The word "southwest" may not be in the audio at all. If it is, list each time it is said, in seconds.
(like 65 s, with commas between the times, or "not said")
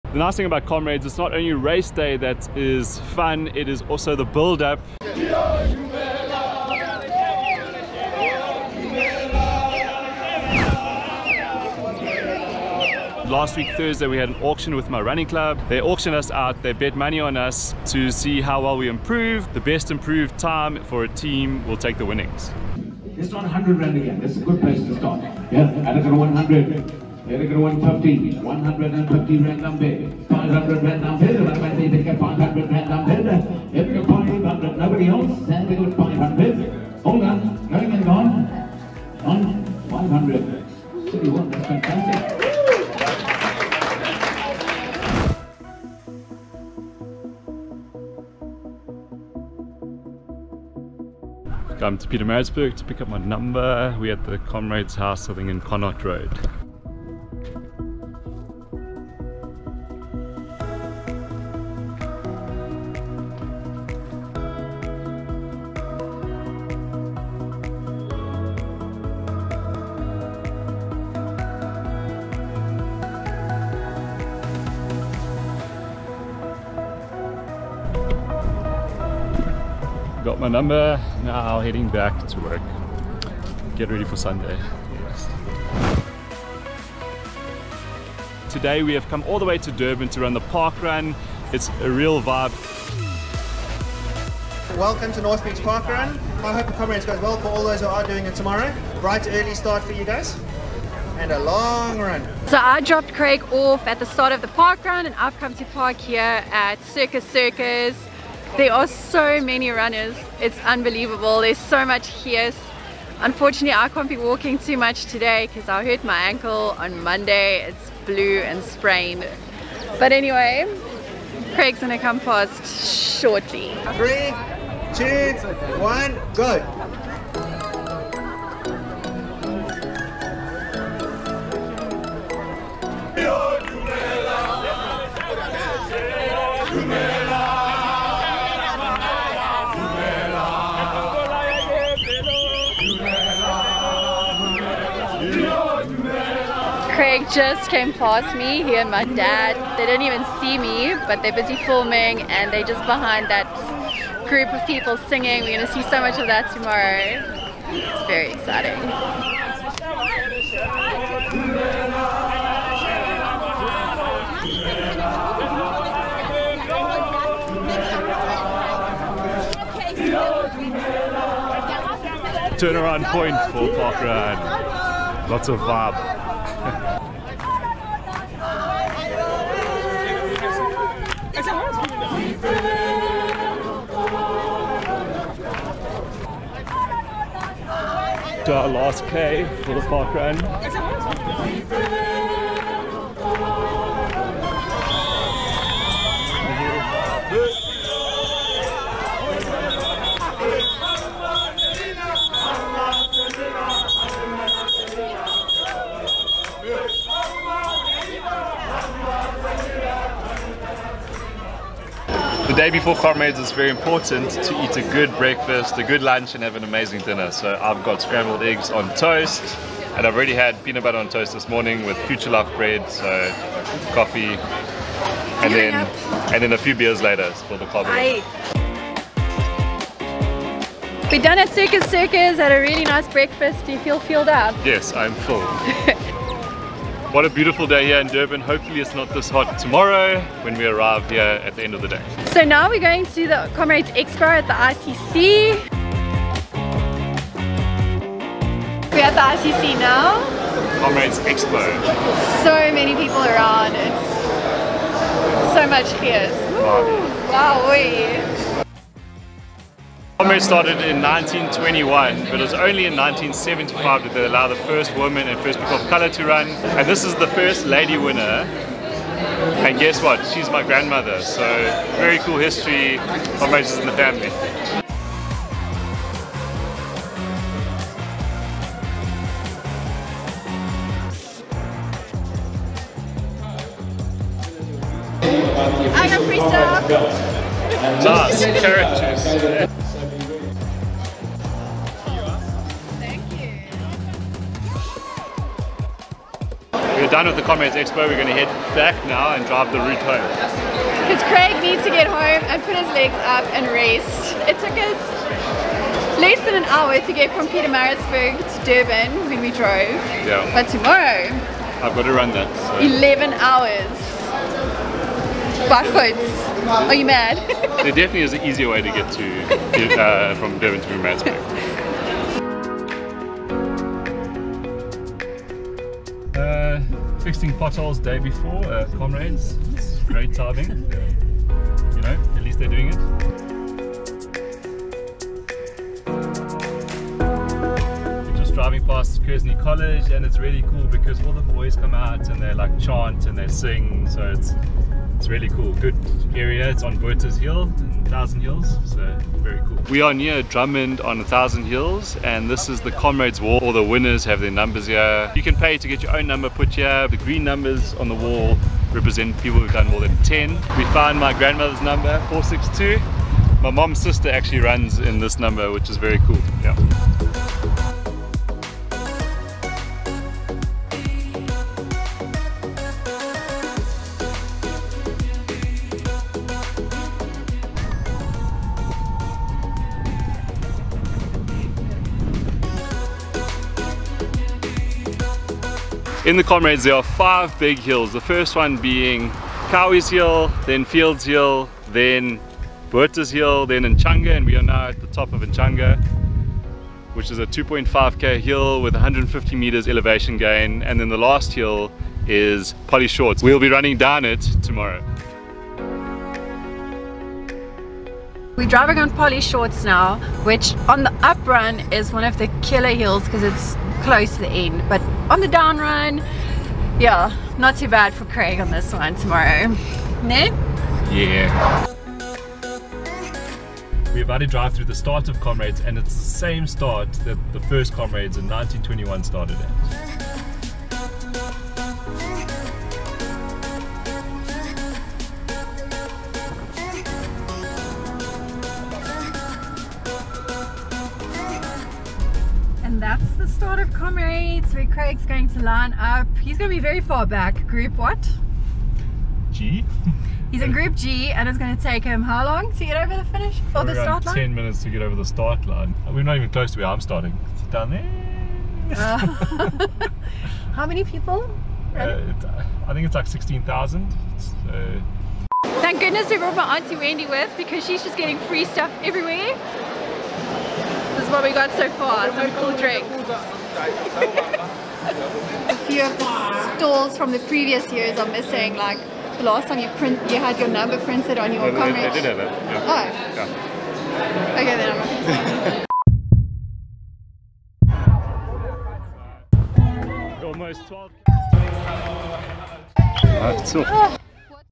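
not said.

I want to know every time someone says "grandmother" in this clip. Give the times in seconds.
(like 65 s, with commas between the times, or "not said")
270 s, 361 s.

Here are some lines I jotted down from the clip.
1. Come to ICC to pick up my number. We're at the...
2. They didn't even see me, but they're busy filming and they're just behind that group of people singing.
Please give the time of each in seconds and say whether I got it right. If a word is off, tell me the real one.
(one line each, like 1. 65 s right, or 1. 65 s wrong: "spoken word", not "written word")
1. 51 s wrong: "Pietermaritzburg", not "ICC"
2. 149 s right.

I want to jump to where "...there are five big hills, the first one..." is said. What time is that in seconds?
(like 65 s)
386 s.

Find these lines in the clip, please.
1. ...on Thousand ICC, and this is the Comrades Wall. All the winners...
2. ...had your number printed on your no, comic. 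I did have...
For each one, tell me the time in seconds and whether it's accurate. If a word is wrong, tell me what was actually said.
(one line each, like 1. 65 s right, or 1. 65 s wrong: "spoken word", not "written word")
1. 351 s wrong: "Hills", not "ICC"
2. 480 s right.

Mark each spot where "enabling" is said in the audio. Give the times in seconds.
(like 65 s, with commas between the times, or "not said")
not said.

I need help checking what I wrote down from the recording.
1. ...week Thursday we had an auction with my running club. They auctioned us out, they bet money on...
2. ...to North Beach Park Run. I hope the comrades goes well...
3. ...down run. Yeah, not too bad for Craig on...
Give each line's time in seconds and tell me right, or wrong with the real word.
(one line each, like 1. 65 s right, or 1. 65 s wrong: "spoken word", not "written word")
1. 13 s right
2. 95 s right
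3. 415 s right.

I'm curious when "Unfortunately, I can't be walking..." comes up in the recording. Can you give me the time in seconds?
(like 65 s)
113 s.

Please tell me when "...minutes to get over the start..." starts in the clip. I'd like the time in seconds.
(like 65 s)
454 s.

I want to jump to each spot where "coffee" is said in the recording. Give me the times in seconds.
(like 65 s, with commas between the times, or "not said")
223 s.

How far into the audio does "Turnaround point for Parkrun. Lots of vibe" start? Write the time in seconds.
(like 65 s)
172 s.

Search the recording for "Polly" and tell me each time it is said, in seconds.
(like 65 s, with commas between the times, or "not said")
402 s, 409 s.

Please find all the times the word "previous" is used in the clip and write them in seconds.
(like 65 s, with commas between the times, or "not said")
477 s.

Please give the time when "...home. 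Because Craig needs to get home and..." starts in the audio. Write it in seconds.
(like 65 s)
300 s.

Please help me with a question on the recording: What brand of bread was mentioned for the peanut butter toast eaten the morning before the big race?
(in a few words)
Future Life.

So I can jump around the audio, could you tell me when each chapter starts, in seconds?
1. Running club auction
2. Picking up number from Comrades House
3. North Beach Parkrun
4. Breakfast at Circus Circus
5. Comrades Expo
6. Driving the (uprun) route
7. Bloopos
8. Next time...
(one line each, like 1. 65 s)
1. 19 s
2. 47 s
3. 88 s
4. 208 s
5. 245 s
6. 322 s
7. 465 s
8. 485 s.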